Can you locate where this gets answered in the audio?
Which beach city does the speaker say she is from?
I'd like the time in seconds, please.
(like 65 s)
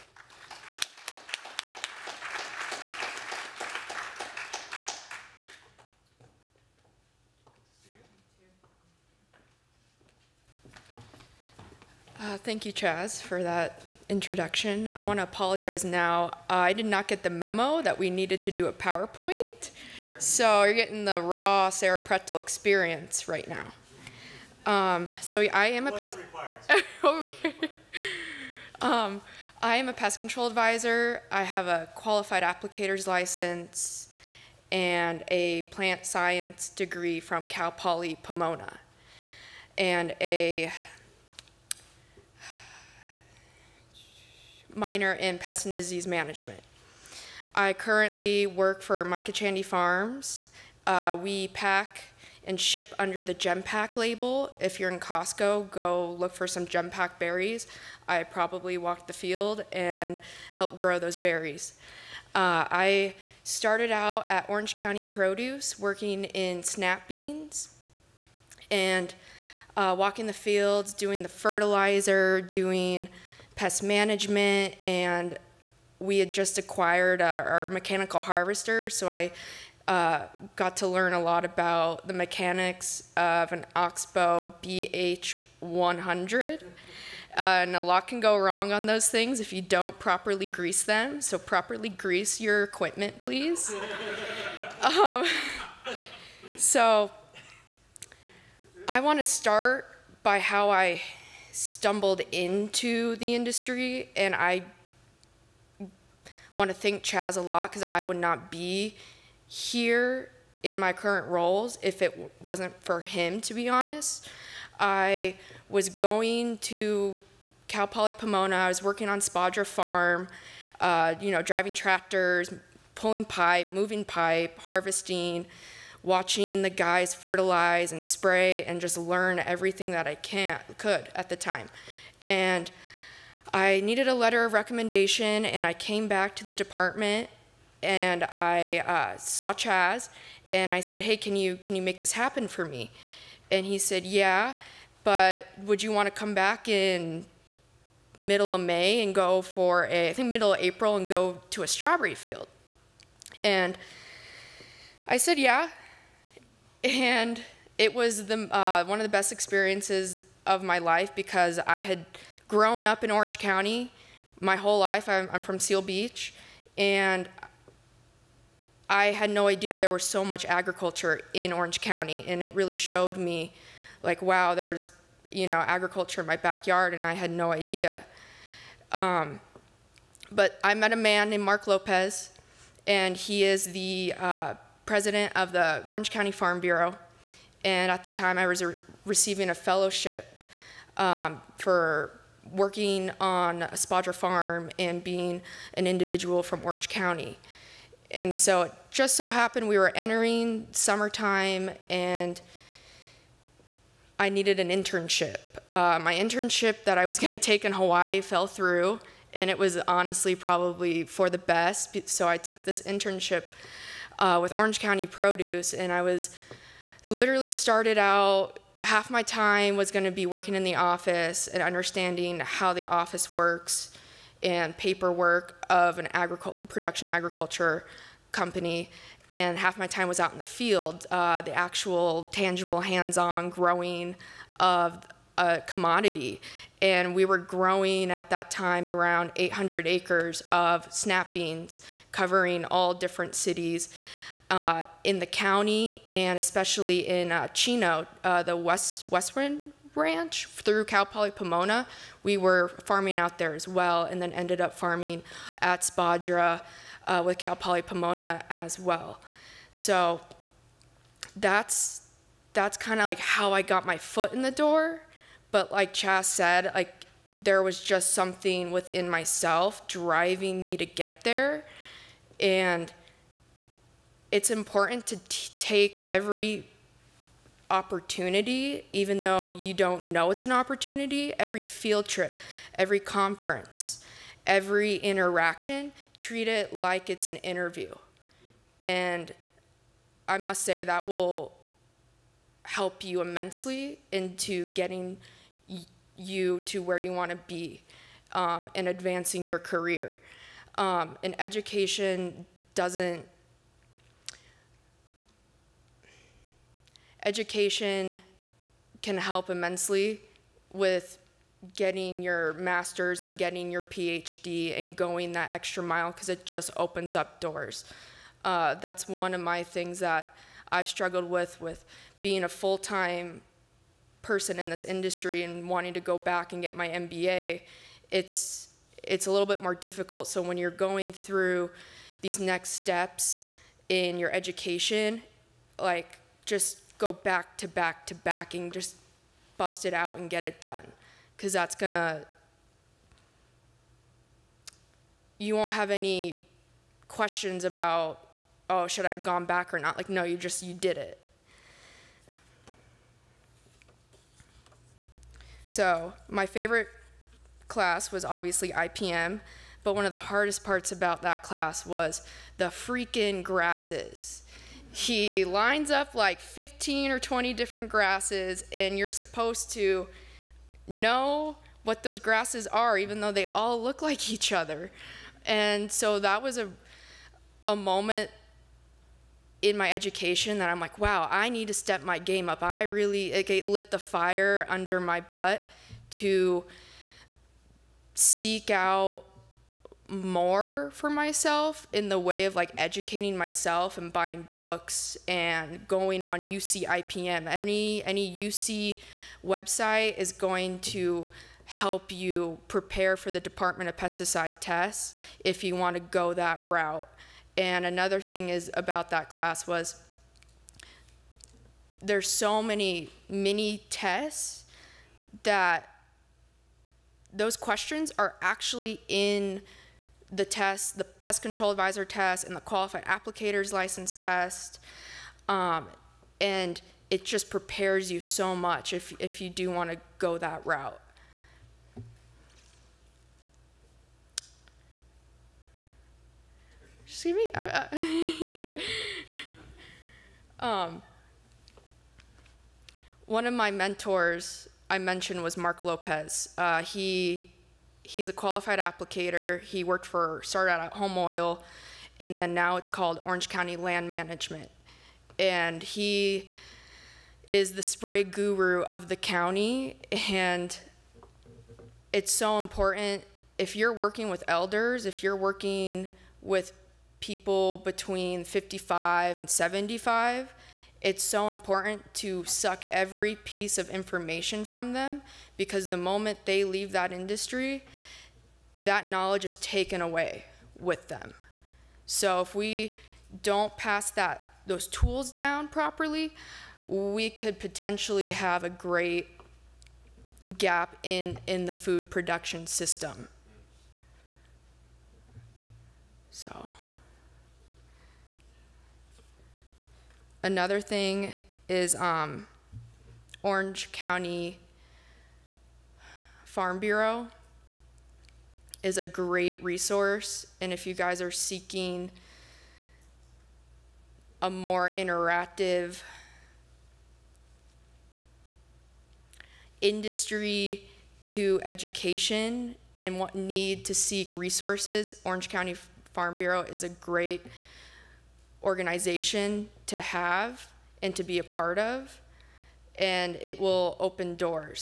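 165 s.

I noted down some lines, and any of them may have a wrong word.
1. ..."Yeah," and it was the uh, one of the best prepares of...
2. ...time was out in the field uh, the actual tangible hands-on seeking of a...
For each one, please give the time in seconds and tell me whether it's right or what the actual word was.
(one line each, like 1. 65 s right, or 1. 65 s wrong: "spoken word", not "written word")
1. 155 s wrong: "experiences", not "prepares"
2. 229 s wrong: "growing", not "seeking".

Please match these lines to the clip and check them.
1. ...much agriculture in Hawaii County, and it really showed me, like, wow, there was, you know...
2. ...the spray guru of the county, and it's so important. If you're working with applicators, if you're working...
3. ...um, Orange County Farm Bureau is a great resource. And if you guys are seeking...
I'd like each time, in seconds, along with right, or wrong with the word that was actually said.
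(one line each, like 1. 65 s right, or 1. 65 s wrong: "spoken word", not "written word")
1. 170 s wrong: "Orange", not "Hawaii"
2. 457 s wrong: "elders", not "applicators"
3. 501 s right.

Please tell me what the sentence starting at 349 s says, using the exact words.
Like, no, you just, you did it.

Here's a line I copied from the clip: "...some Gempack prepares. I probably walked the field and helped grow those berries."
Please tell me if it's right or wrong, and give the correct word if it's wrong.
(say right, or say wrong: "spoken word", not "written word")
wrong: "berries", not "prepares".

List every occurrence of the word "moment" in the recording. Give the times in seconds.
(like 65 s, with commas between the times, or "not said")
377 s, 475 s.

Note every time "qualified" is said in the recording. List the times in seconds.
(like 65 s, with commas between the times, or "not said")
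31 s, 422 s, 448 s.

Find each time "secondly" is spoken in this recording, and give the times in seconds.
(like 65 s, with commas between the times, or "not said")
not said.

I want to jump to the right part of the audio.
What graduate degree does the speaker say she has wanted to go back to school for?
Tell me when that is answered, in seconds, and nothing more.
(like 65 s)
326 s.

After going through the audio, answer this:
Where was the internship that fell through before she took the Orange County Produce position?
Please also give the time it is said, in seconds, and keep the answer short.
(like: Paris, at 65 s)
Hawaii, at 207 s.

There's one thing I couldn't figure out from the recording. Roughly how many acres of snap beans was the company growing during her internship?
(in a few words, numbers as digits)
800.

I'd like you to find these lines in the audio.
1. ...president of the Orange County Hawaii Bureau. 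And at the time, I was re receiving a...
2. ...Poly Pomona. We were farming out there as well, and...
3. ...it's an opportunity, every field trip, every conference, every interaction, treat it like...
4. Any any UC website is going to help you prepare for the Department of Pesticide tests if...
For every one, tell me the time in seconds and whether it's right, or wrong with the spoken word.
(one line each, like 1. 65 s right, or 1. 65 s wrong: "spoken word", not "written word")
1. 184 s wrong: "Farm", not "Hawaii"
2. 251 s right
3. 280 s right
4. 397 s right.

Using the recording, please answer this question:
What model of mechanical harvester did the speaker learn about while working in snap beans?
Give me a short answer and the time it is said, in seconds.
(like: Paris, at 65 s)
Oxbo BH100, at 83 s.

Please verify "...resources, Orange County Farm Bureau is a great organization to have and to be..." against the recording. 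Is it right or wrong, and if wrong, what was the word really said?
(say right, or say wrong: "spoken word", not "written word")
right.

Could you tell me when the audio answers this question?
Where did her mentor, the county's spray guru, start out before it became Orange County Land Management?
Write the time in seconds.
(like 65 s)
450 s.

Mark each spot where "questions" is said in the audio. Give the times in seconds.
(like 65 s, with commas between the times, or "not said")
347 s, 417 s.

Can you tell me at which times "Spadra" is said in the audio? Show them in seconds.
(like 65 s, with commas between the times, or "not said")
119 s, 193 s, 255 s.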